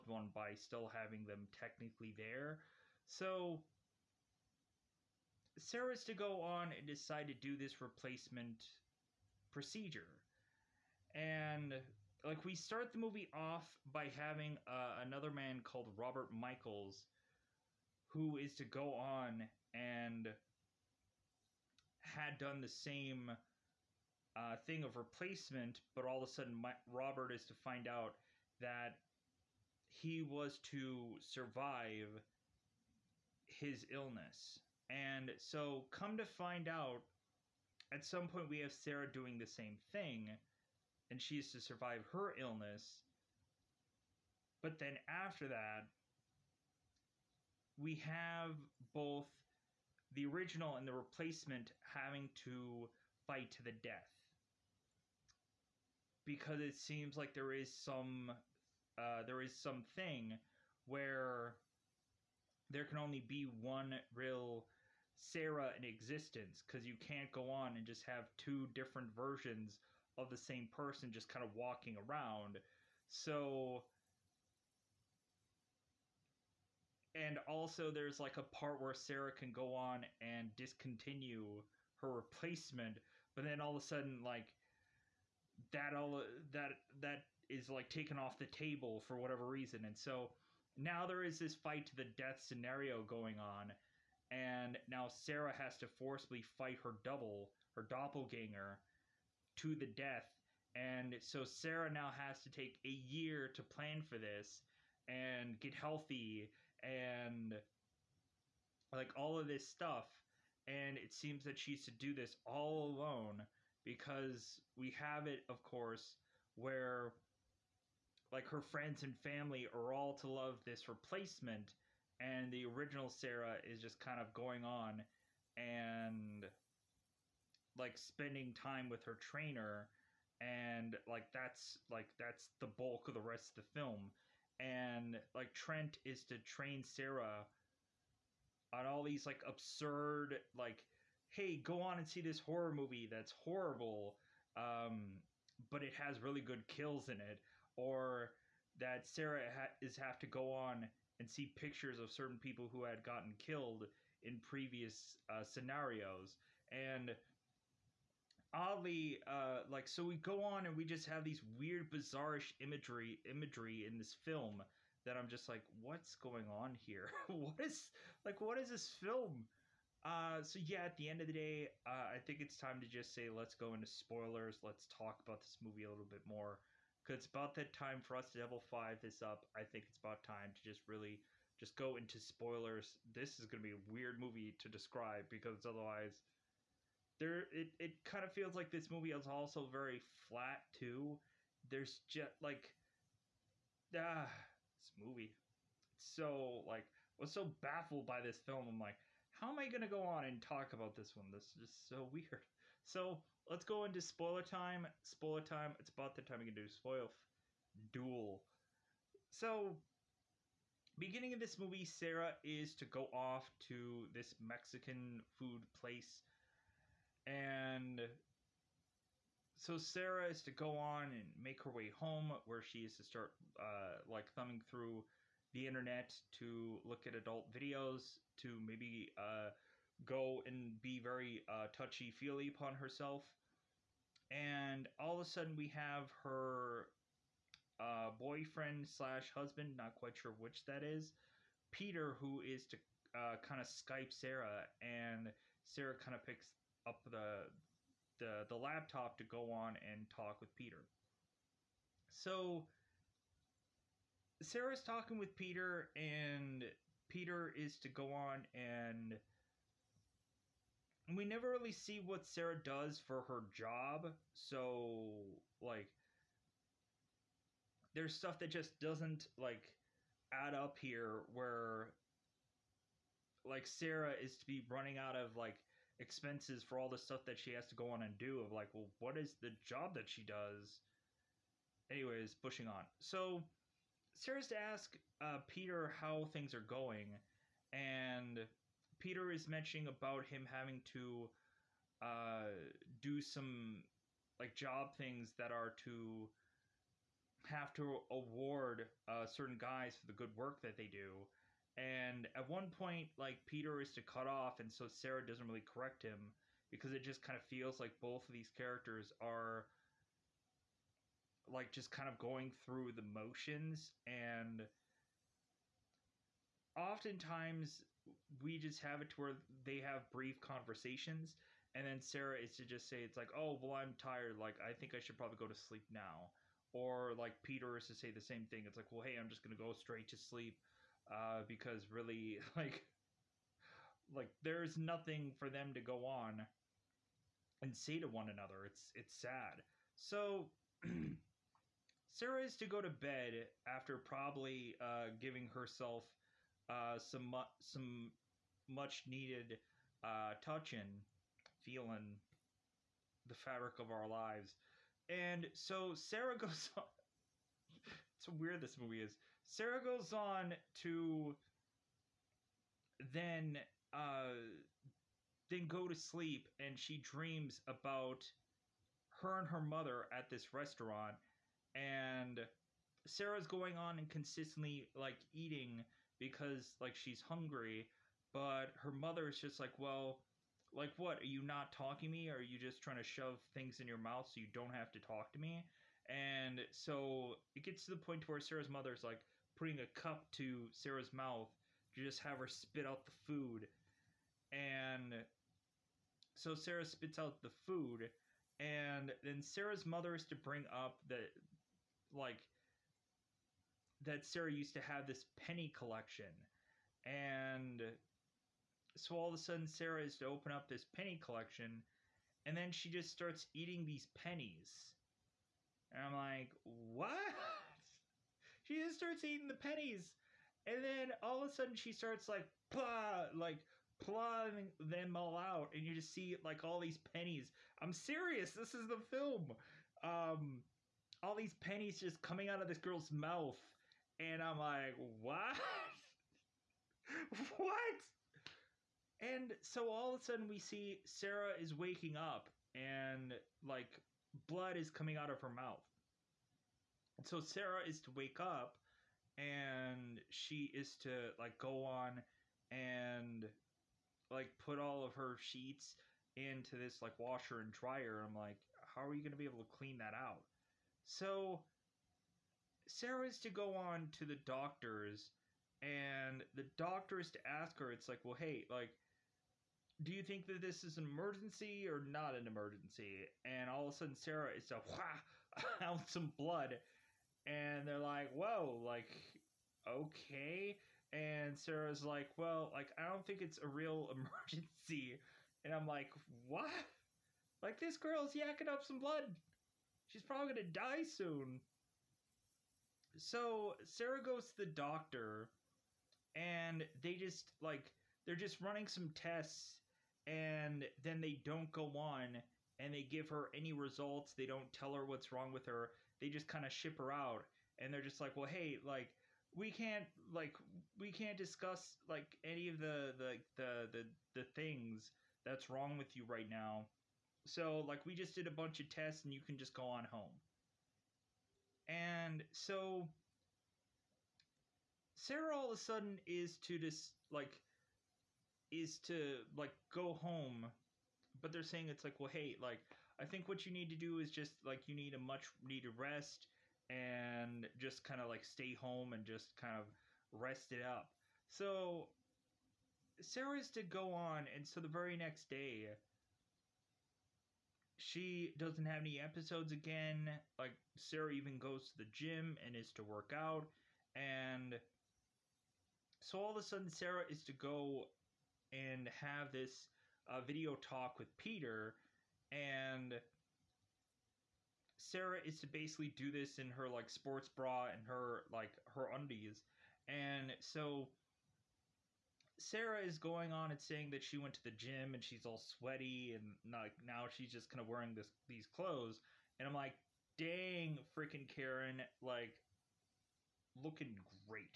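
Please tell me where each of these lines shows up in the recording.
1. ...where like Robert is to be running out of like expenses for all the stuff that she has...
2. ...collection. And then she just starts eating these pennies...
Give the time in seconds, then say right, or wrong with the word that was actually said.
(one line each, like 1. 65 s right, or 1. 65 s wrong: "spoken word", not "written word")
1. 271 s wrong: "Sarah", not "Robert"
2. 411 s right.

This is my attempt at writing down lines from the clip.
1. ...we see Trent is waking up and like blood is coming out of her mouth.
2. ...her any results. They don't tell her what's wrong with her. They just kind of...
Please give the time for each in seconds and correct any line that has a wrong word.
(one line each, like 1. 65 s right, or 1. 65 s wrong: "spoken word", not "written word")
1. 440 s wrong: "Sarah", not "Trent"
2. 503 s right.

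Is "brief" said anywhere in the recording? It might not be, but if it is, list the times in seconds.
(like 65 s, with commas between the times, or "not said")
320 s.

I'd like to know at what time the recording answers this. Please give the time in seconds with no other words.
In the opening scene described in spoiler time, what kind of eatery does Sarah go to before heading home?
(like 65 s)
214 s.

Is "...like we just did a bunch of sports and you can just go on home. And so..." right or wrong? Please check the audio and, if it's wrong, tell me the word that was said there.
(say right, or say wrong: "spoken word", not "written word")
wrong: "tests", not "sports".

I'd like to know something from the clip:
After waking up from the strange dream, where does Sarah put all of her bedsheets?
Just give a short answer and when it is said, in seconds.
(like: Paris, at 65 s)
Washer and dryer, at 457 s.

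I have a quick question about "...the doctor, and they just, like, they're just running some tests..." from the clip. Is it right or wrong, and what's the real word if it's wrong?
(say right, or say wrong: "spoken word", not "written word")
right.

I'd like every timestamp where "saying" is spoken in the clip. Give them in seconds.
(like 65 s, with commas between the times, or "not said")
531 s, 573 s.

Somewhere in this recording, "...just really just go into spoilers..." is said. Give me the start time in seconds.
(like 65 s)
180 s.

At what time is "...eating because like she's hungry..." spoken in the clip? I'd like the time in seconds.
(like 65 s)
375 s.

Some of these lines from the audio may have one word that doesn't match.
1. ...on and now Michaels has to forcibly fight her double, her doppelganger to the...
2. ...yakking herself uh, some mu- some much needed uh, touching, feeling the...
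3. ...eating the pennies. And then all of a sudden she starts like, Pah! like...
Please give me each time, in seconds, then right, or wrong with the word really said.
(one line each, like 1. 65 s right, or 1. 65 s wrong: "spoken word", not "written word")
1. 93 s wrong: "Sarah", not "Michaels"
2. 345 s wrong: "giving", not "yakking"
3. 419 s right.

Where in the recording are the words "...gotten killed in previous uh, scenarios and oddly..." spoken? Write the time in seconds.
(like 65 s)
153 s.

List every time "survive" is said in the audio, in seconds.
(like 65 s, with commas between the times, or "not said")
31 s, 41 s.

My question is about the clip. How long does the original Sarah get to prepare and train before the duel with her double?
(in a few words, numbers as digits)
A year.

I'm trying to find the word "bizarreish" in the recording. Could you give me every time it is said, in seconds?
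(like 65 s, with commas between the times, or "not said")
161 s.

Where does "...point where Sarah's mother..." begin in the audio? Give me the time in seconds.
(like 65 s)
388 s.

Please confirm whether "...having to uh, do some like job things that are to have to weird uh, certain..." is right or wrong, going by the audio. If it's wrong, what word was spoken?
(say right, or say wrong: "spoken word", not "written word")
wrong: "award", not "weird".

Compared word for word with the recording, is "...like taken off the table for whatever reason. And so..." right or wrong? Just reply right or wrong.
right.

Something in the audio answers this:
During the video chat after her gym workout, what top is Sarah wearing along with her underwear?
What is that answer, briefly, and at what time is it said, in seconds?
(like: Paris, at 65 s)
Sports bra, at 567 s.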